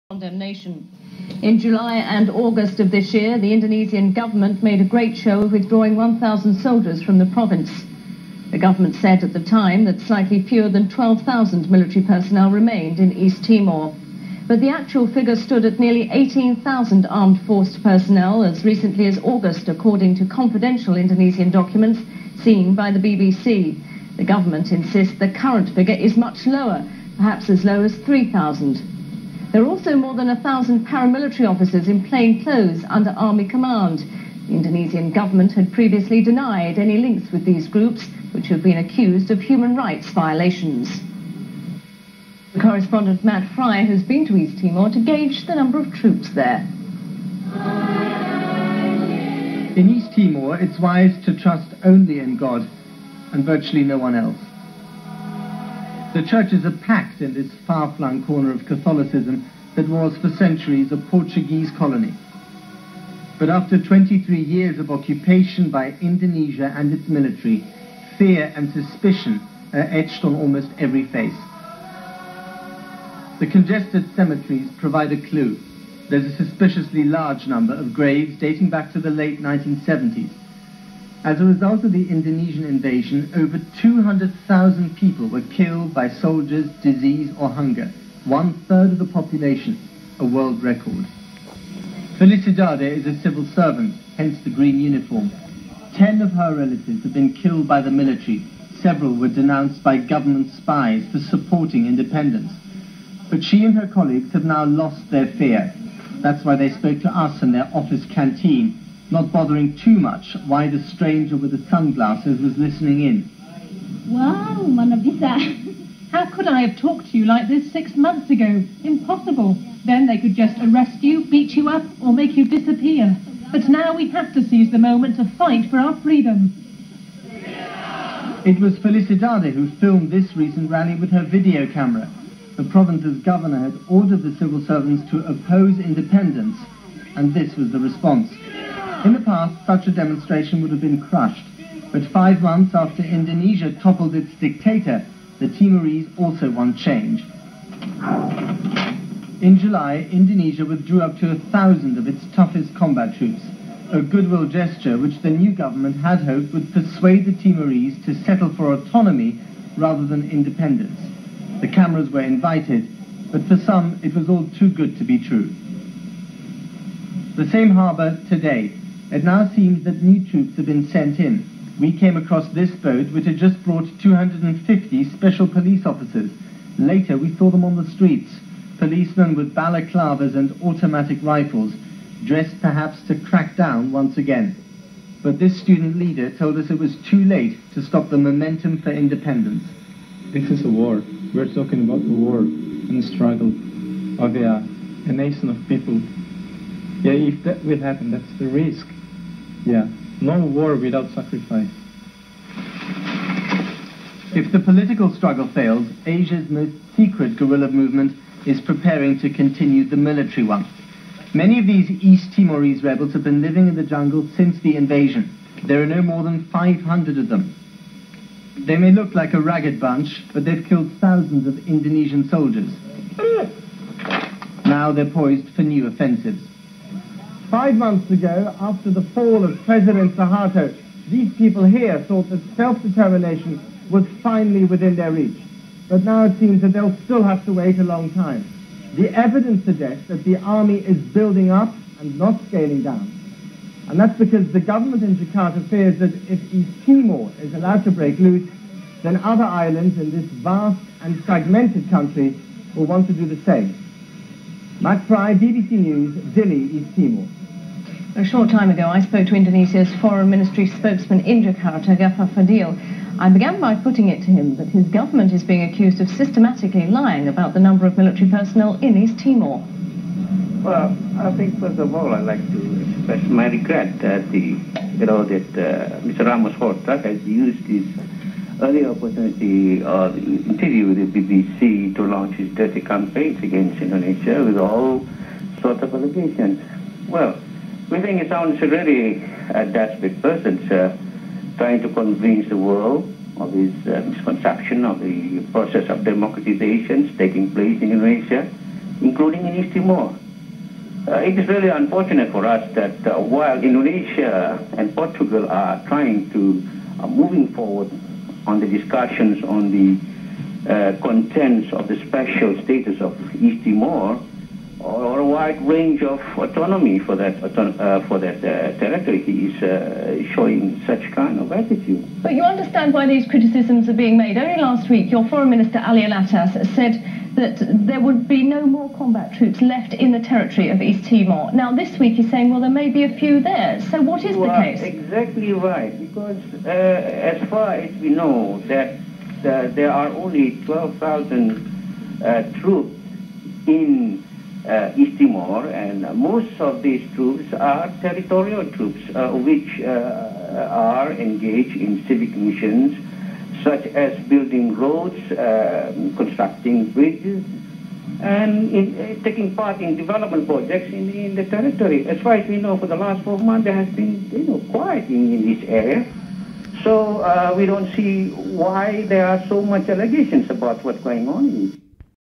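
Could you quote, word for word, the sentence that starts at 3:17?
Yeah, if that will happen, that's the risk.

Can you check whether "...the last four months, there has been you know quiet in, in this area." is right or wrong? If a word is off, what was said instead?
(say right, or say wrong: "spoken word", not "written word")
right.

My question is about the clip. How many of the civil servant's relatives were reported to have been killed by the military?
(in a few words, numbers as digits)
10.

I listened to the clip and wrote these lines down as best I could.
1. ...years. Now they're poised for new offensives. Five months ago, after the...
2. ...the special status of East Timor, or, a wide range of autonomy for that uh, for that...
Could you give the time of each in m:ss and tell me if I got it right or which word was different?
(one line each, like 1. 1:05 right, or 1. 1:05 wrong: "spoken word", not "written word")
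1. 3:42 wrong: "soldiers", not "years"
2. 5:11 right.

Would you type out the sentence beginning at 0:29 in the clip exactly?
There are also more than a thousand paramilitary officers in plain clothes under army command.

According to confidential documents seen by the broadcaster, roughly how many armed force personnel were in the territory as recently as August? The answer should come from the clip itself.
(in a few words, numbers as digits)
nearly 18,000.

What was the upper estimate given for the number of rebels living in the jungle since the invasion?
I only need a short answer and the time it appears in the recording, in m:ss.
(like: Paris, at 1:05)
500, at 3:36.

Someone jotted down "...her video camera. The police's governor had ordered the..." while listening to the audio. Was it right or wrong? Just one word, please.
wrong.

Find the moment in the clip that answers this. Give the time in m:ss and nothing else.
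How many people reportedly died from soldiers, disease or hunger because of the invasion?
1:23.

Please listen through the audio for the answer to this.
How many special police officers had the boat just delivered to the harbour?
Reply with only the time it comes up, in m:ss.
2:53.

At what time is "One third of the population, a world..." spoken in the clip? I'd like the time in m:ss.
1:28.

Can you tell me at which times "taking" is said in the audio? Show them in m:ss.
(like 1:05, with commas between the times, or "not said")
4:57, 5:59.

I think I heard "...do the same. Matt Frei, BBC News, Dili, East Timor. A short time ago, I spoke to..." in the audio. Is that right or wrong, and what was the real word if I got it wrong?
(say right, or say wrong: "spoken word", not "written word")
right.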